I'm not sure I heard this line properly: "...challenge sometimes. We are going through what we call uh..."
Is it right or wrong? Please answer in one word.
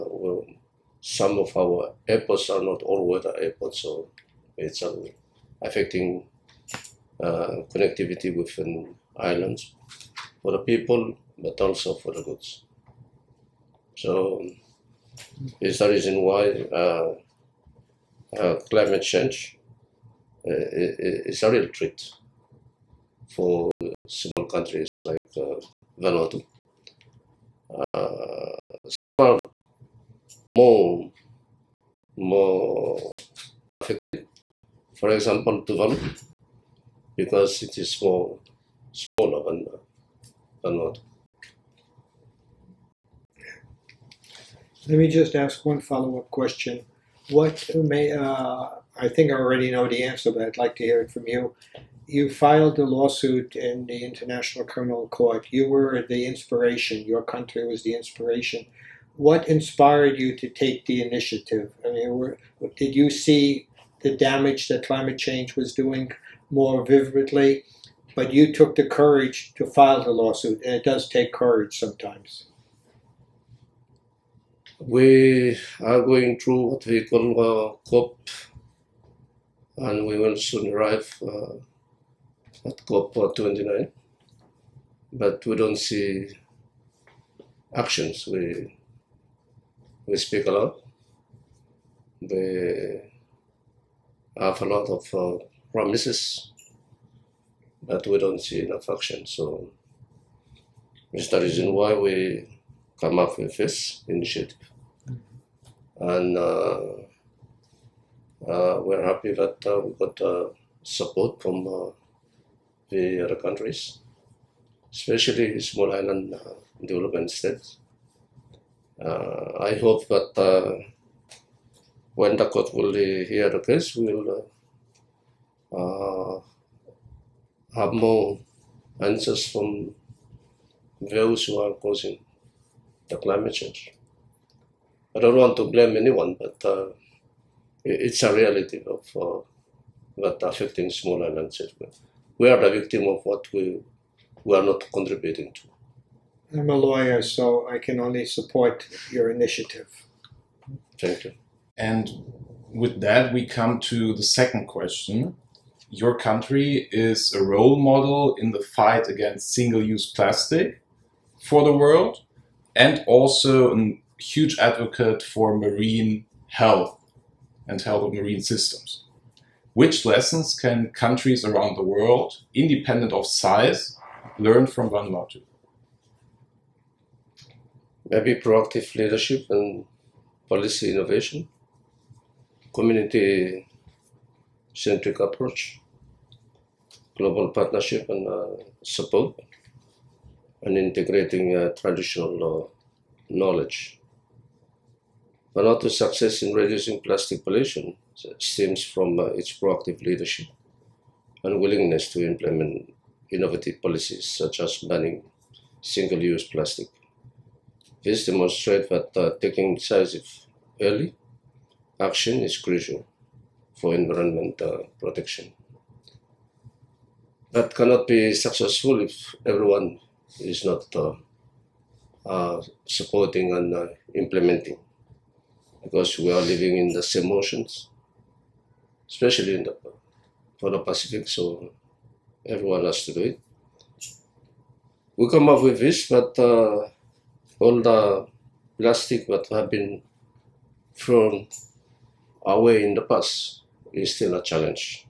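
wrong.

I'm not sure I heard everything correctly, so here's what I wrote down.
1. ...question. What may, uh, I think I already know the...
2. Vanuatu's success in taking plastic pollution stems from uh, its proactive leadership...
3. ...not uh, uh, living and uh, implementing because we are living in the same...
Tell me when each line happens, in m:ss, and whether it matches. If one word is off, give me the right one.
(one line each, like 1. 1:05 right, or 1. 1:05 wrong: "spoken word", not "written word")
1. 0:46 right
2. 3:15 wrong: "reducing", not "taking"
3. 3:40 wrong: "supporting", not "living".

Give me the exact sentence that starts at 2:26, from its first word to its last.
I'm a lawyer, so I can only support your initiative.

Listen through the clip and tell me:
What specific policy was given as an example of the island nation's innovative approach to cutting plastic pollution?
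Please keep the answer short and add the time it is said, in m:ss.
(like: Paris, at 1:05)
Banning single-use plastic, at 3:24.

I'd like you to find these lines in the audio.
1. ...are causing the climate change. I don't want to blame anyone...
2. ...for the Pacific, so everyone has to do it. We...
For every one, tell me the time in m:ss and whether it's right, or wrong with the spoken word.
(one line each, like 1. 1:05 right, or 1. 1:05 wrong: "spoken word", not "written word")
1. 2:11 right
2. 3:50 right.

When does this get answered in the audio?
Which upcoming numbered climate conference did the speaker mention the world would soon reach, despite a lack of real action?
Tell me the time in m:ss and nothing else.
1:22.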